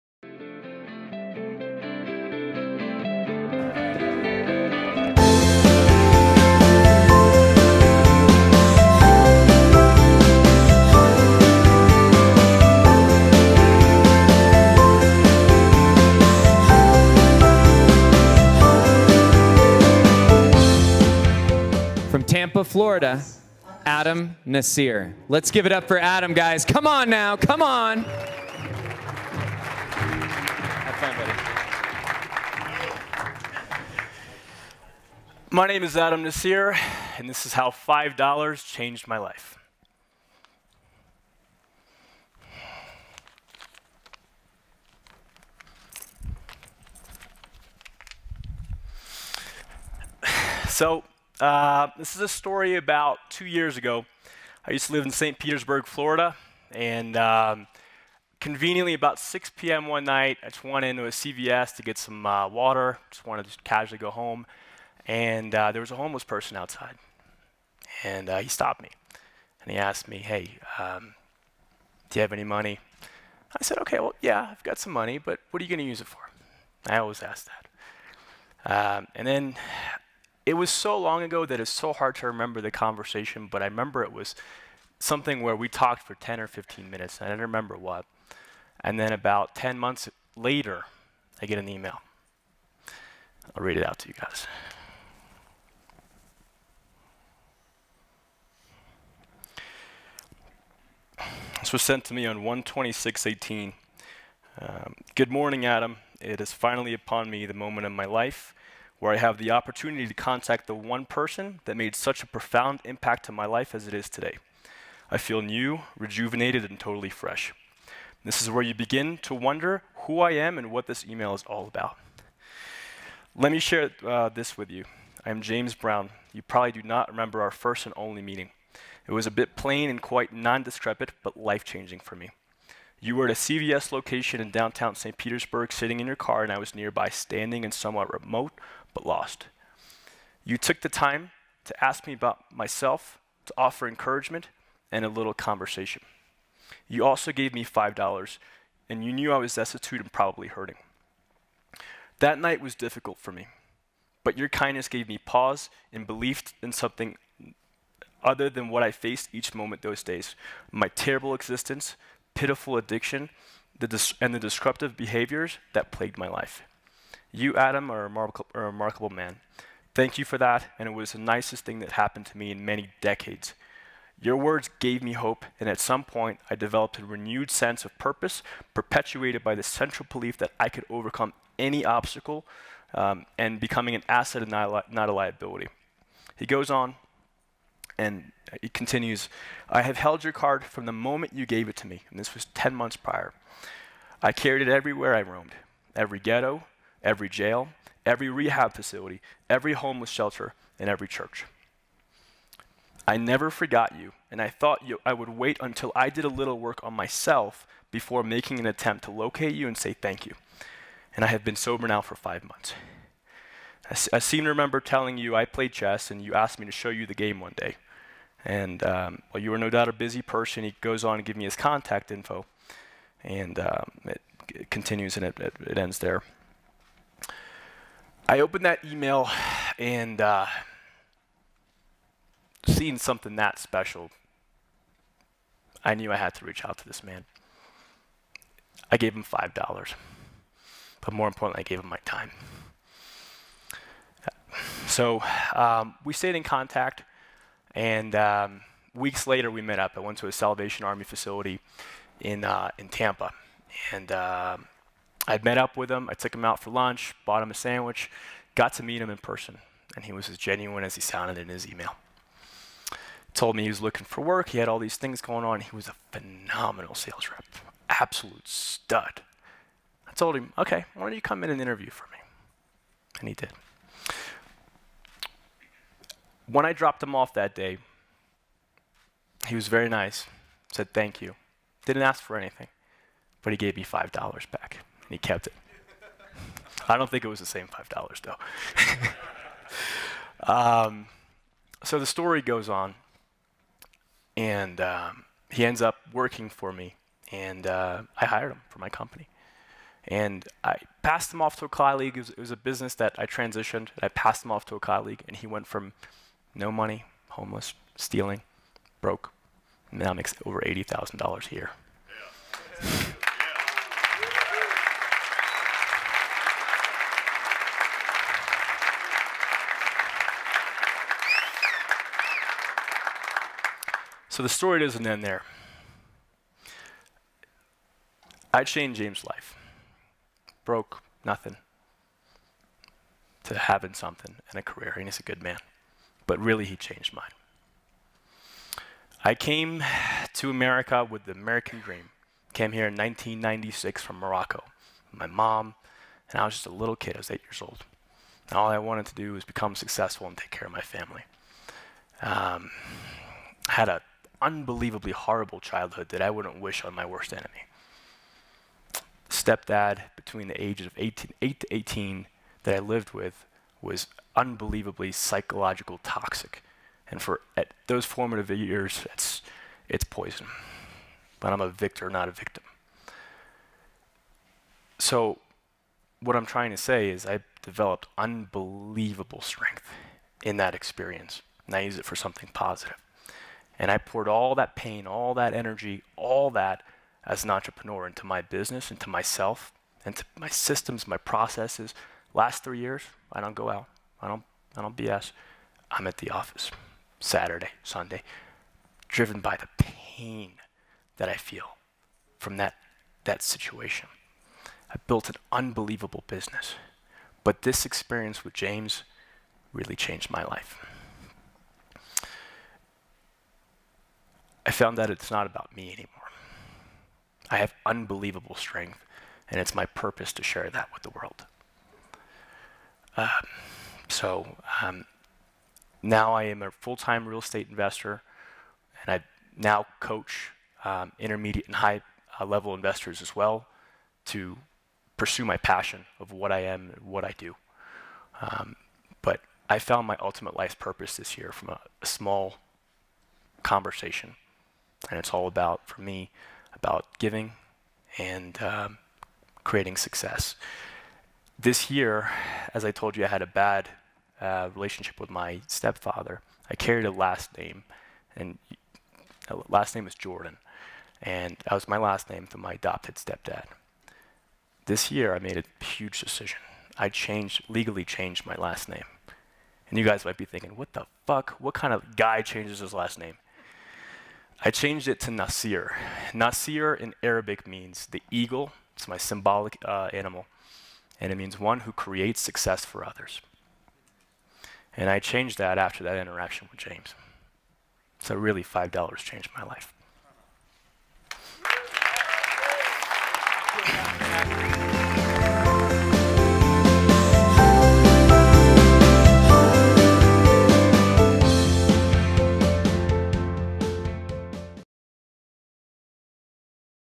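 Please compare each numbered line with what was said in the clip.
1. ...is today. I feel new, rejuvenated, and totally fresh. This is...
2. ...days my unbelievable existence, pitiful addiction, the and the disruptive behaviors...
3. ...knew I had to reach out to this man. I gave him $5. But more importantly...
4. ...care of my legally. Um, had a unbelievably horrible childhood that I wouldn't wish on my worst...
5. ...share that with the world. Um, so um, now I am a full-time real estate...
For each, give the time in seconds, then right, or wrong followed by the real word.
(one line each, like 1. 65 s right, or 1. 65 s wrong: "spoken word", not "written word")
1. 113 s right
2. 160 s wrong: "terrible", not "unbelievable"
3. 235 s right
4. 350 s wrong: "family", not "legally"
5. 420 s right.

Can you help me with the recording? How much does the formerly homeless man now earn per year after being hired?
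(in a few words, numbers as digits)
Over $80,000.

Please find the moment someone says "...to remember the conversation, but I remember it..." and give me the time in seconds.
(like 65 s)
82 s.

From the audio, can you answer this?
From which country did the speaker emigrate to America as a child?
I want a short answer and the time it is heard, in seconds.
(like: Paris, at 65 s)
Morocco, at 344 s.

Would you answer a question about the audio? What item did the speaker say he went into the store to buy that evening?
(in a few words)
Water.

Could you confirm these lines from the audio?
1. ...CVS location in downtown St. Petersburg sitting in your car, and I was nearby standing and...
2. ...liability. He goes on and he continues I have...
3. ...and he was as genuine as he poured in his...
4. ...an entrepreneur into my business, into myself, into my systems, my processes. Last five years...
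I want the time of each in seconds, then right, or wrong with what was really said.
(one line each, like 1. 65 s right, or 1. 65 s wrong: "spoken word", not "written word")
1. 133 s right
2. 185 s right
3. 259 s wrong: "sounded", not "poured"
4. 387 s wrong: "three", not "five".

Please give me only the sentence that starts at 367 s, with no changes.
And for at those formative years, it's, it's poison.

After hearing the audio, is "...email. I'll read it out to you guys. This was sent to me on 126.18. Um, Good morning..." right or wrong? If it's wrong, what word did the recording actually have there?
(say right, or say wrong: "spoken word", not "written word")
right.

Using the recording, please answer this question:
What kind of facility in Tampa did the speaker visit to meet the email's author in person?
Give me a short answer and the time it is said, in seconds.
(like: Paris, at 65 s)
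Salvation Army, at 250 s.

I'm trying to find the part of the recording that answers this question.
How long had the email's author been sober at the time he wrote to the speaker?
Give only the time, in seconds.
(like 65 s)
212 s.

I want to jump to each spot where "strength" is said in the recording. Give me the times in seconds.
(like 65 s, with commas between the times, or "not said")
379 s, 418 s.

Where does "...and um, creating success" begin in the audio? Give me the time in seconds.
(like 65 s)
448 s.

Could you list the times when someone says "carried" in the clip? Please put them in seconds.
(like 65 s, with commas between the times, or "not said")
194 s, 456 s.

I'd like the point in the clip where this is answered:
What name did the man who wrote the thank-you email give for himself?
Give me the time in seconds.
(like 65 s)
125 s.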